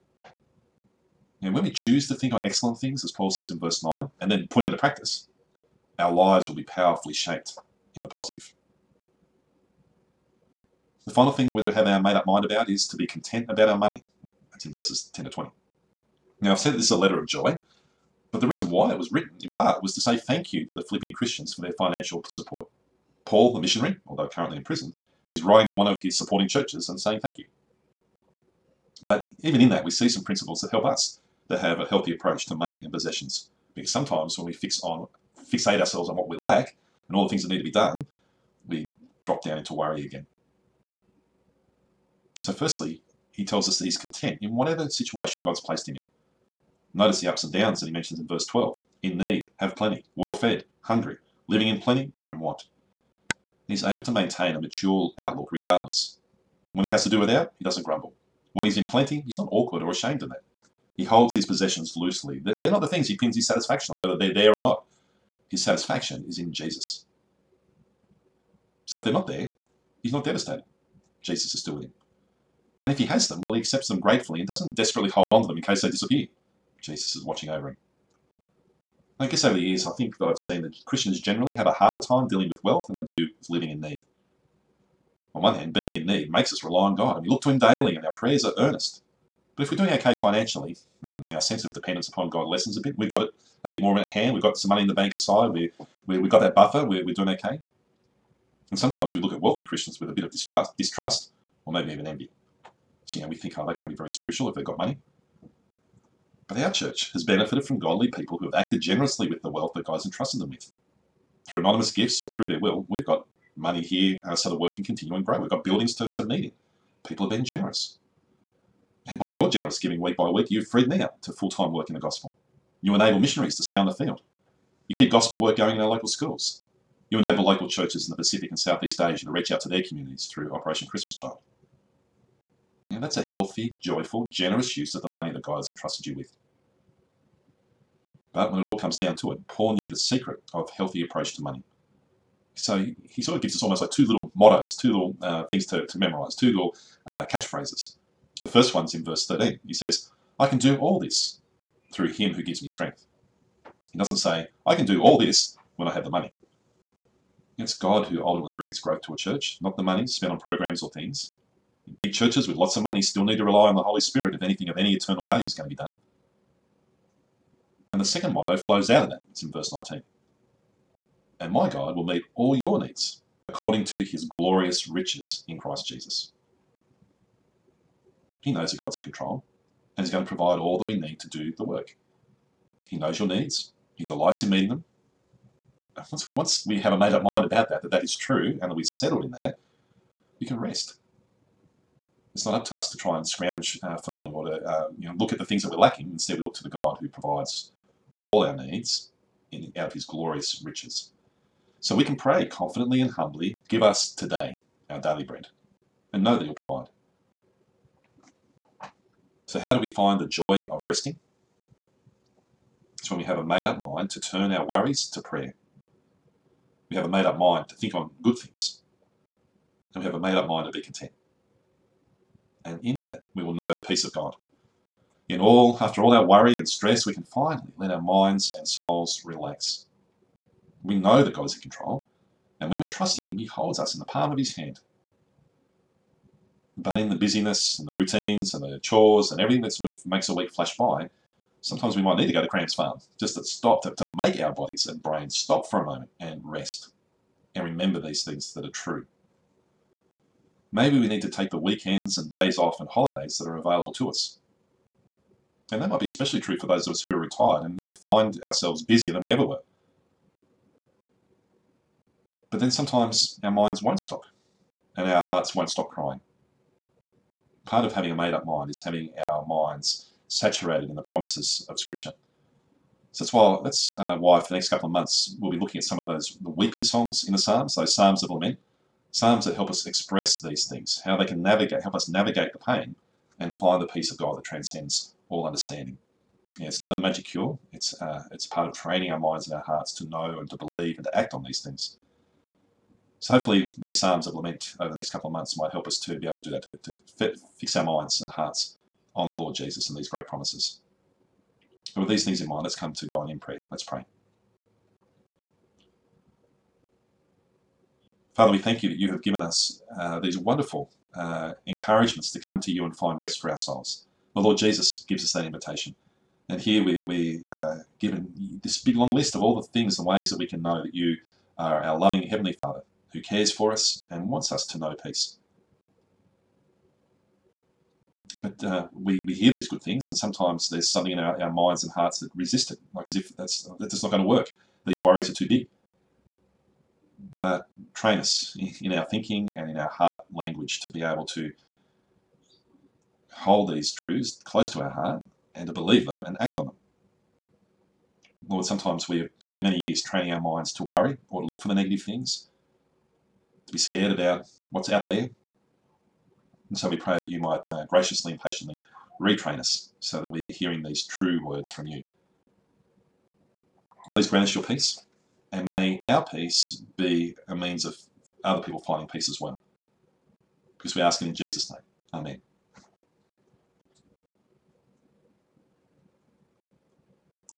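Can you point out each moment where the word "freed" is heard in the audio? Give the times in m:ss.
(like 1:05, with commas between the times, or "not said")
2:00.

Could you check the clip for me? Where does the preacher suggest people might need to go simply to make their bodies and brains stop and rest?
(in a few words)
Cram's Farm.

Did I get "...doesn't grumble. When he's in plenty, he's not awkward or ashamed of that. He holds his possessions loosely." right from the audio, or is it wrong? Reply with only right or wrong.
right.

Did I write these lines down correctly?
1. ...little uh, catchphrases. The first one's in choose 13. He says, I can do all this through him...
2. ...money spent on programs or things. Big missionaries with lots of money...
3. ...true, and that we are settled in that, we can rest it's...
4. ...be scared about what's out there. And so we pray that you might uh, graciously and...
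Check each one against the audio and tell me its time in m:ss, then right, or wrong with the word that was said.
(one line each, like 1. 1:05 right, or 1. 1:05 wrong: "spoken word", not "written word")
1. 2:26 wrong: "verse", not "choose"
2. 2:39 wrong: "churches", not "missionaries"
3. 3:08 right
4. 5:53 right.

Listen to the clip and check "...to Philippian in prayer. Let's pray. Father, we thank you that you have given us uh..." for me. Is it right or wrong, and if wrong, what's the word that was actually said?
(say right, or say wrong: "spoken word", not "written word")
wrong: "God", not "Philippian".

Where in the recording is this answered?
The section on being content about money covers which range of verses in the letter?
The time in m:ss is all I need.
0:14.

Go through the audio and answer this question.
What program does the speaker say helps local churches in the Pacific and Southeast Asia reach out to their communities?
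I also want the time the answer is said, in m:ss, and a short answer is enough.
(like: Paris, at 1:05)
Operation Christmas Child, at 2:10.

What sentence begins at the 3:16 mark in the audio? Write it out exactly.
Instead, we look to the God who provides all our needs in, out of his glorious riches.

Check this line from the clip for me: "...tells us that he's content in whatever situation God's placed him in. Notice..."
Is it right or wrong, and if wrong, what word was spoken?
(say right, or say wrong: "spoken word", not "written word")
right.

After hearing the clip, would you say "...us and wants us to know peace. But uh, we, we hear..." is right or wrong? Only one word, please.
right.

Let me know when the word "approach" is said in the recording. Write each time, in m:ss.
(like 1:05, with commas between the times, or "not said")
0:32, 2:21.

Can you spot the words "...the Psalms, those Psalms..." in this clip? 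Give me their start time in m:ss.
4:37.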